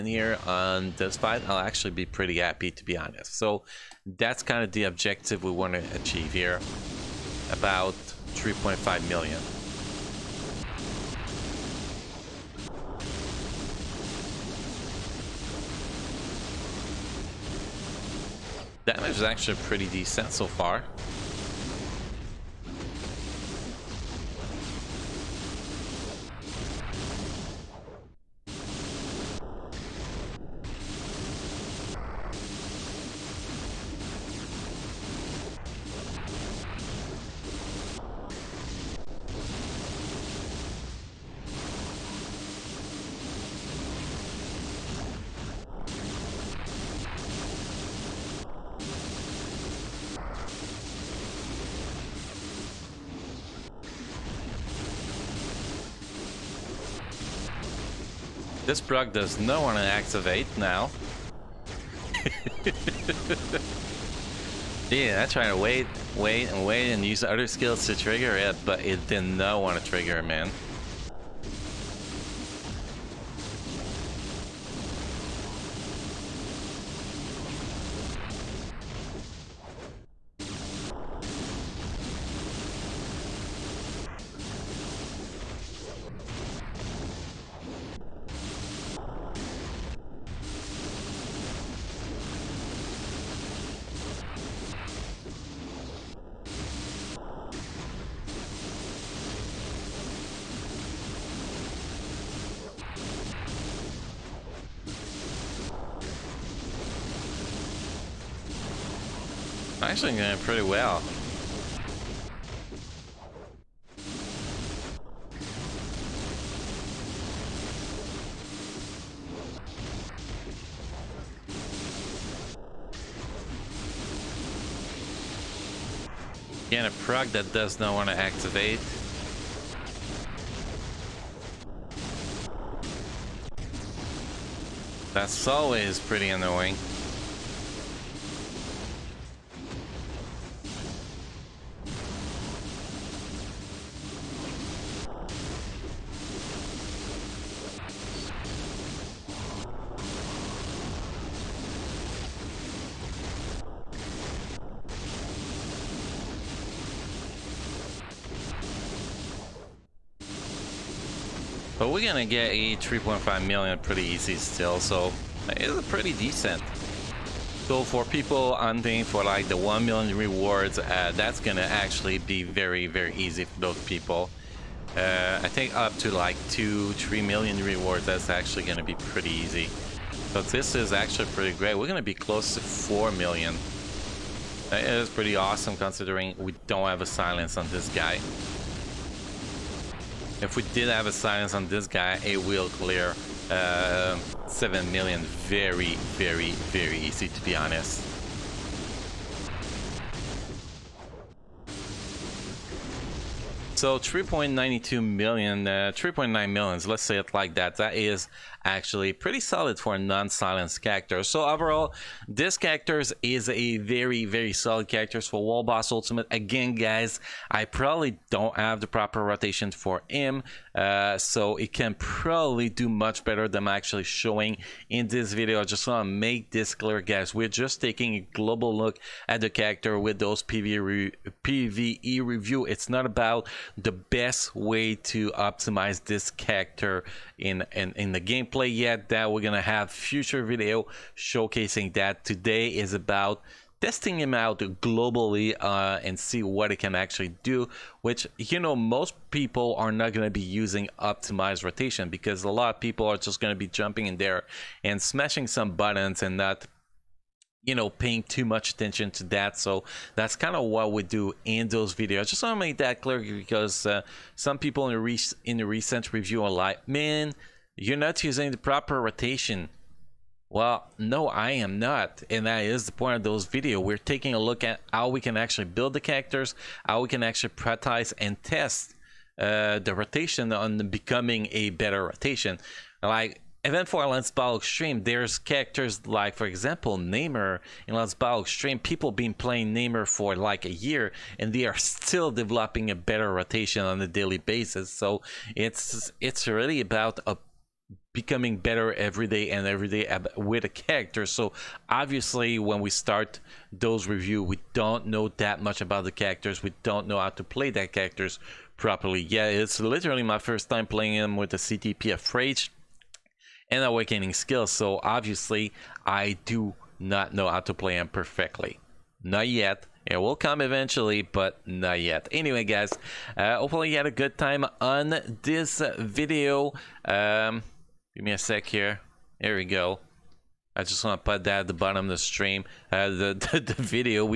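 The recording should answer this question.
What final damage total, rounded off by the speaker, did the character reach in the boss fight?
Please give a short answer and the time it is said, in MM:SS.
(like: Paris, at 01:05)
3.9 million, at 03:25.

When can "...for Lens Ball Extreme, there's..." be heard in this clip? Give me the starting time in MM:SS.
04:43.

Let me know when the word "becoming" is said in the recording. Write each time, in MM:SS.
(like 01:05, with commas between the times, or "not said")
04:40, 04:58.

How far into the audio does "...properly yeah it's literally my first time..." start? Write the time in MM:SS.
05:08.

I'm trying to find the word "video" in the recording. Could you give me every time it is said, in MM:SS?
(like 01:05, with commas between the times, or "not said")
03:45, 04:00, 04:21, 04:33, 05:25, 05:33.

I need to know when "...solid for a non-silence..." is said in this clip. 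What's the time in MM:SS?
03:29.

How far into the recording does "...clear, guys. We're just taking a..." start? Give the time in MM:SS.
03:46.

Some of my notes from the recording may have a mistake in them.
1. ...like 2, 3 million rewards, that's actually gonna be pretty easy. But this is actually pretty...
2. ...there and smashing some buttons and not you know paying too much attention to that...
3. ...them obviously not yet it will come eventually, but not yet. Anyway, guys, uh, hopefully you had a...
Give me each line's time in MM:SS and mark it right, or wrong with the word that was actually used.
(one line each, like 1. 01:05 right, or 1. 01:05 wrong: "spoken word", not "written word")
1. 02:56 right
2. 04:14 right
3. 05:17 wrong: "perfectly", not "obviously".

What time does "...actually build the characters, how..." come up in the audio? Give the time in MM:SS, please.
04:35.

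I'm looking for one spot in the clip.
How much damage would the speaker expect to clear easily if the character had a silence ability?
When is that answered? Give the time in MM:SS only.
03:14.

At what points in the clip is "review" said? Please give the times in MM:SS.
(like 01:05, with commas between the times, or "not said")
03:52, 04:26, 05:04.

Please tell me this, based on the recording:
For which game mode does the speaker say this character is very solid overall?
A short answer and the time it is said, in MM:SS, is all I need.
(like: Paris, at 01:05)
World Boss Ultimate, at 03:35.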